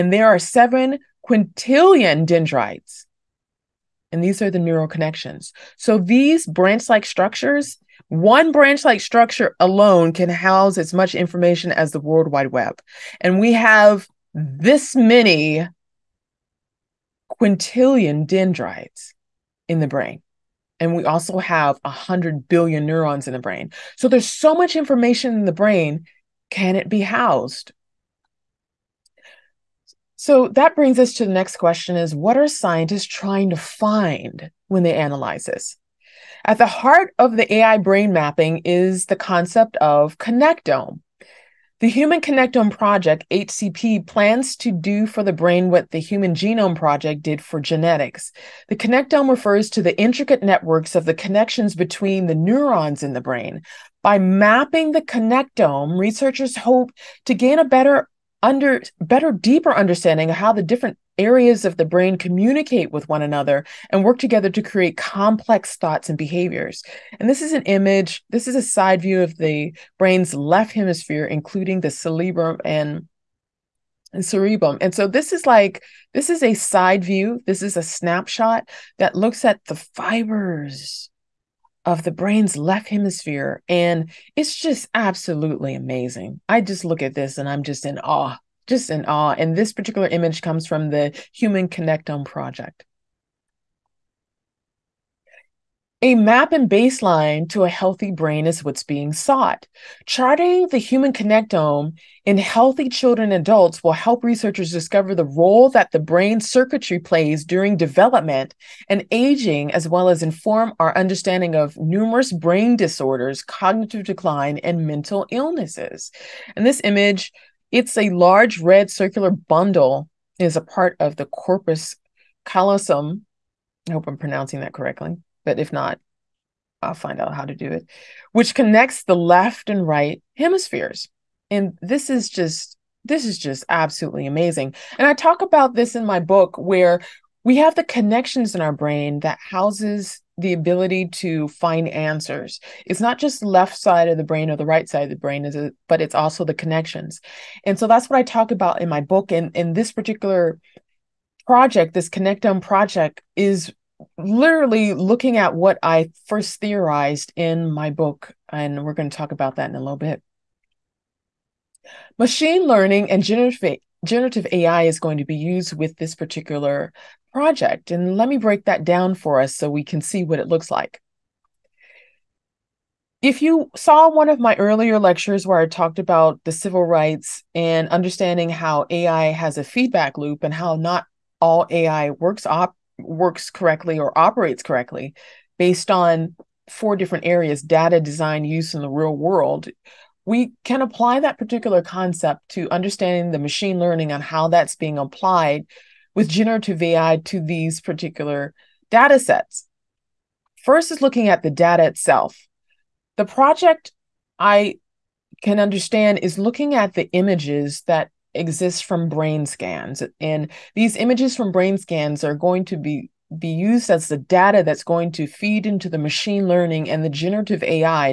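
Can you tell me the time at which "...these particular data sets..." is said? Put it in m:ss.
3:17.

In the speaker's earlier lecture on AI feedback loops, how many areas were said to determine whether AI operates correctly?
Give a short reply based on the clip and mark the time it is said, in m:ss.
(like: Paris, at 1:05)
4, at 3:06.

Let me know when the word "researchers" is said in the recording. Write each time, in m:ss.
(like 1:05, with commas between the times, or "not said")
0:55, 1:44.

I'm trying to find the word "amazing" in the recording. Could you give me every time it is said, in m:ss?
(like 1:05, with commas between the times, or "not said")
1:25, 2:14.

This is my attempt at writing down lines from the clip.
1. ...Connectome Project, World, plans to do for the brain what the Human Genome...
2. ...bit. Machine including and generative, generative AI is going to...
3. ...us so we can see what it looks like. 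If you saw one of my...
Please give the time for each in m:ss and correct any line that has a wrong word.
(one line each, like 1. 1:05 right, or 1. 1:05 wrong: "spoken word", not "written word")
1. 0:42 wrong: "HCP", not "World"
2. 2:39 wrong: "learning", not "including"
3. 2:49 right.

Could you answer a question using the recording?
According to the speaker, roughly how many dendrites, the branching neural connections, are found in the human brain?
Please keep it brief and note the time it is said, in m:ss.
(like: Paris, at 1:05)
7 quintillion, at 0:00.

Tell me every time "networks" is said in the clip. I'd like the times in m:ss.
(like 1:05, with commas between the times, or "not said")
0:50.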